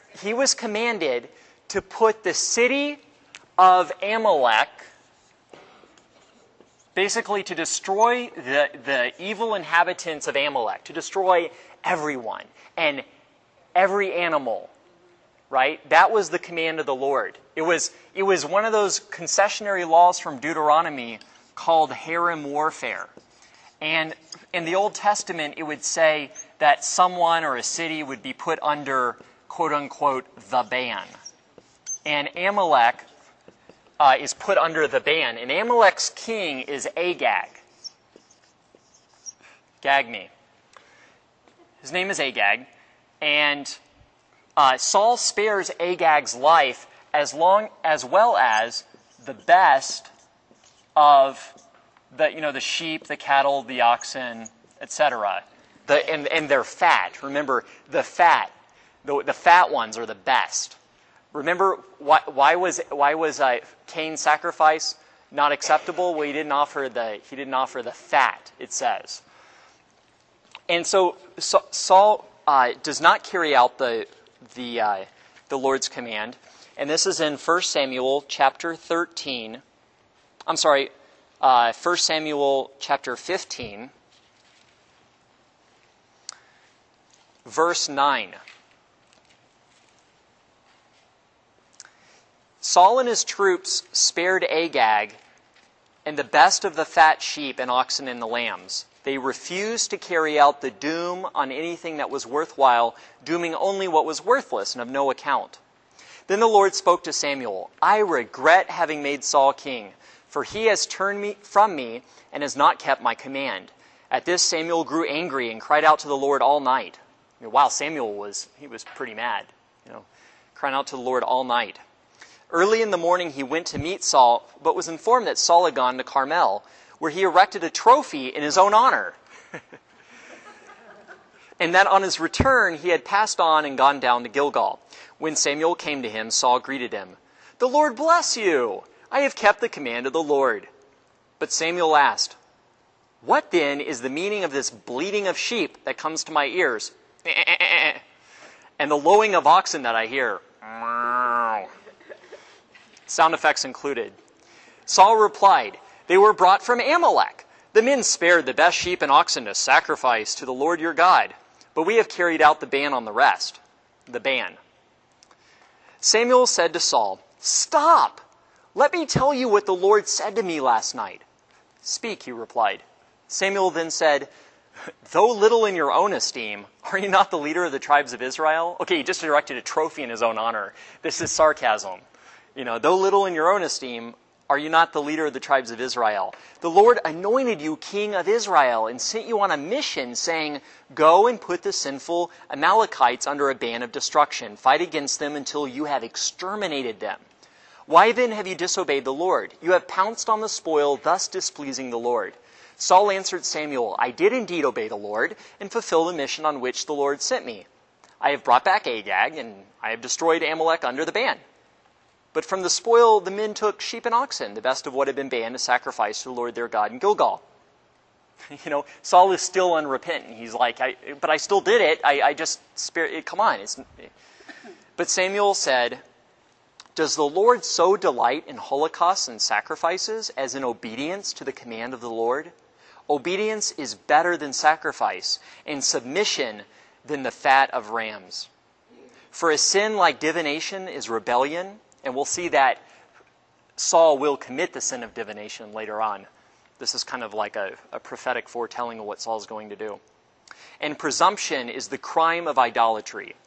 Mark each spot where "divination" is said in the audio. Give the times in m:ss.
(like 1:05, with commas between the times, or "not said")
4:00, 4:05.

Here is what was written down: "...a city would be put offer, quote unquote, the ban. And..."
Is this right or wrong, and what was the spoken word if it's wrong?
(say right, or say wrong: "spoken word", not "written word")
wrong: "under", not "offer".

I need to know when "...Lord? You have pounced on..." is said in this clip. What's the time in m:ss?
3:19.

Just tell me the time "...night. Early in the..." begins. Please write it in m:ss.
2:01.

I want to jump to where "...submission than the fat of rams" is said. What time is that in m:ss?
3:55.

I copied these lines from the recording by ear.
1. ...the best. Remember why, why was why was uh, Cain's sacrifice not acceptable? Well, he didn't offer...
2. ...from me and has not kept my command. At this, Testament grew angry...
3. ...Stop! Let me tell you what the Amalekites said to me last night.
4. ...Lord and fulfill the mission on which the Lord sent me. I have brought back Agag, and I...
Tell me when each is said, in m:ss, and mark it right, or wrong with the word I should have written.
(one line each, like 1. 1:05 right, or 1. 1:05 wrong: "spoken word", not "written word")
1. 1:00 right
2. 1:51 wrong: "Samuel", not "Testament"
3. 2:47 wrong: "Lord", not "Amalekites"
4. 3:24 right.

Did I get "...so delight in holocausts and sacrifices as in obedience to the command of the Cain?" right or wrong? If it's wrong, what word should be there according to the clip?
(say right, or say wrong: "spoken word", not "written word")
wrong: "Lord", not "Cain".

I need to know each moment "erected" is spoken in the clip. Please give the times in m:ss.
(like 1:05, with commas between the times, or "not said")
2:07, 2:59.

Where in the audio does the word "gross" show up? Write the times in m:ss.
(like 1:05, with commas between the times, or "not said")
not said.